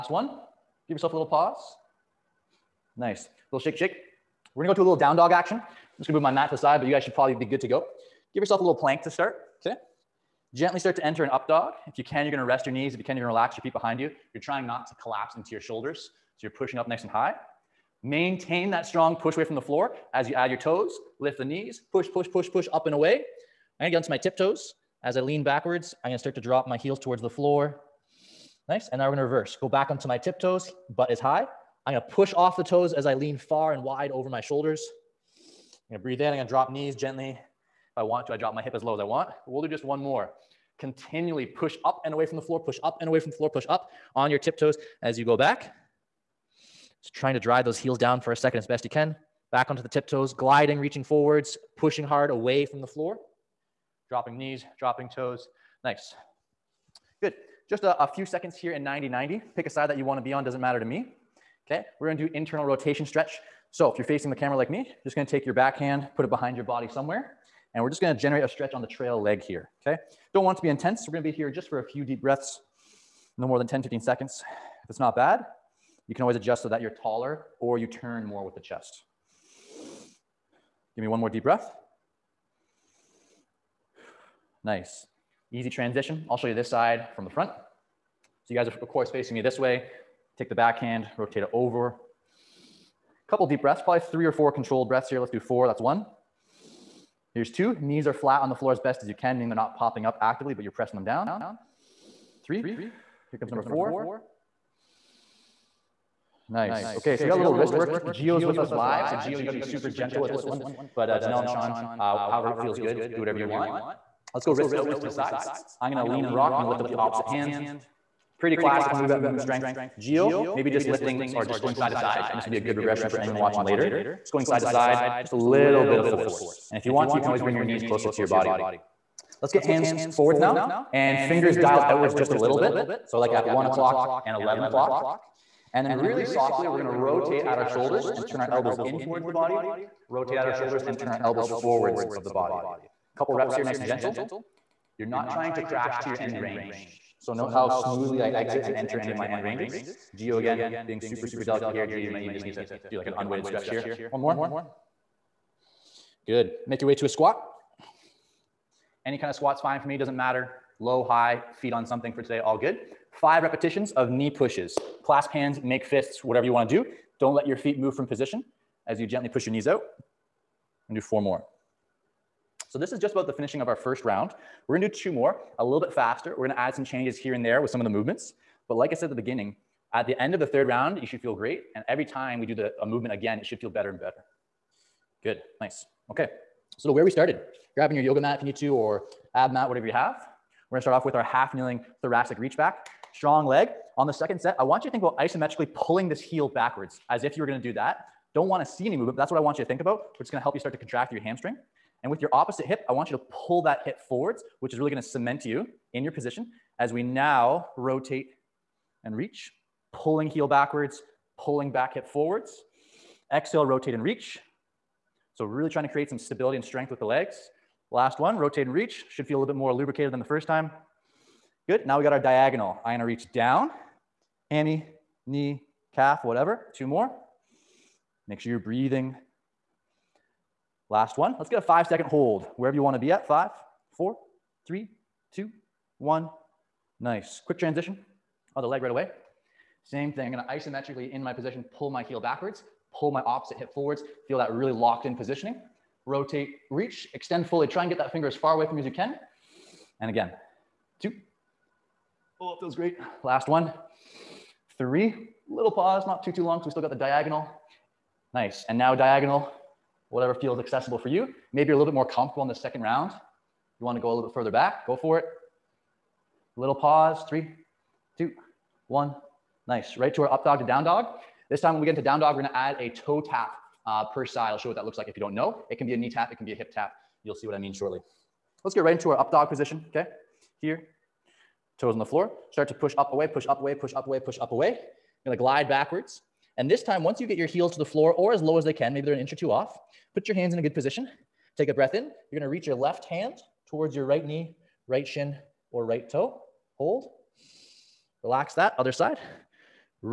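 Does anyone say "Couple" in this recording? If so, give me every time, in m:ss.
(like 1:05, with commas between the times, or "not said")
1:33, 2:23.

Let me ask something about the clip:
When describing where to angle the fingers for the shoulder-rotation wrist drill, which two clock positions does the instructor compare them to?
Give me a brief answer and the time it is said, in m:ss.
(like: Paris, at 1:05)
1 o'clock and 11 o'clock, at 2:13.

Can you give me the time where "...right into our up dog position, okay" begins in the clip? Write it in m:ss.
4:38.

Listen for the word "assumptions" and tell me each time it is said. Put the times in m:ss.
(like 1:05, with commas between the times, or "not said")
not said.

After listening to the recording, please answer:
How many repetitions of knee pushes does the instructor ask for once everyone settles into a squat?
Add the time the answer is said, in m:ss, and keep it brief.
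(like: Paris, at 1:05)
5, at 2:43.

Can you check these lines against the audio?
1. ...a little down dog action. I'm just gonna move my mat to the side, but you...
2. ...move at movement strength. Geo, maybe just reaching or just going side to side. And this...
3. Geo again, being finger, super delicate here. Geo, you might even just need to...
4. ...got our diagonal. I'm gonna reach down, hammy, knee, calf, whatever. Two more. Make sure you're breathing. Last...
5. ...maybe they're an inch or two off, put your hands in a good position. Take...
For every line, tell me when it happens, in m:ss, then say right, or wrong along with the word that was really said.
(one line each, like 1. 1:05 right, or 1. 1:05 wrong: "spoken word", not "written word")
1. 0:04 right
2. 1:58 wrong: "lifting", not "reaching"
3. 2:30 wrong: "super", not "finger"
4. 3:42 right
5. 4:48 right.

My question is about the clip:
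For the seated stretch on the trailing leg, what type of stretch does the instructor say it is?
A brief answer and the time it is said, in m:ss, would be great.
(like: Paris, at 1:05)
internal rotation, at 1:02.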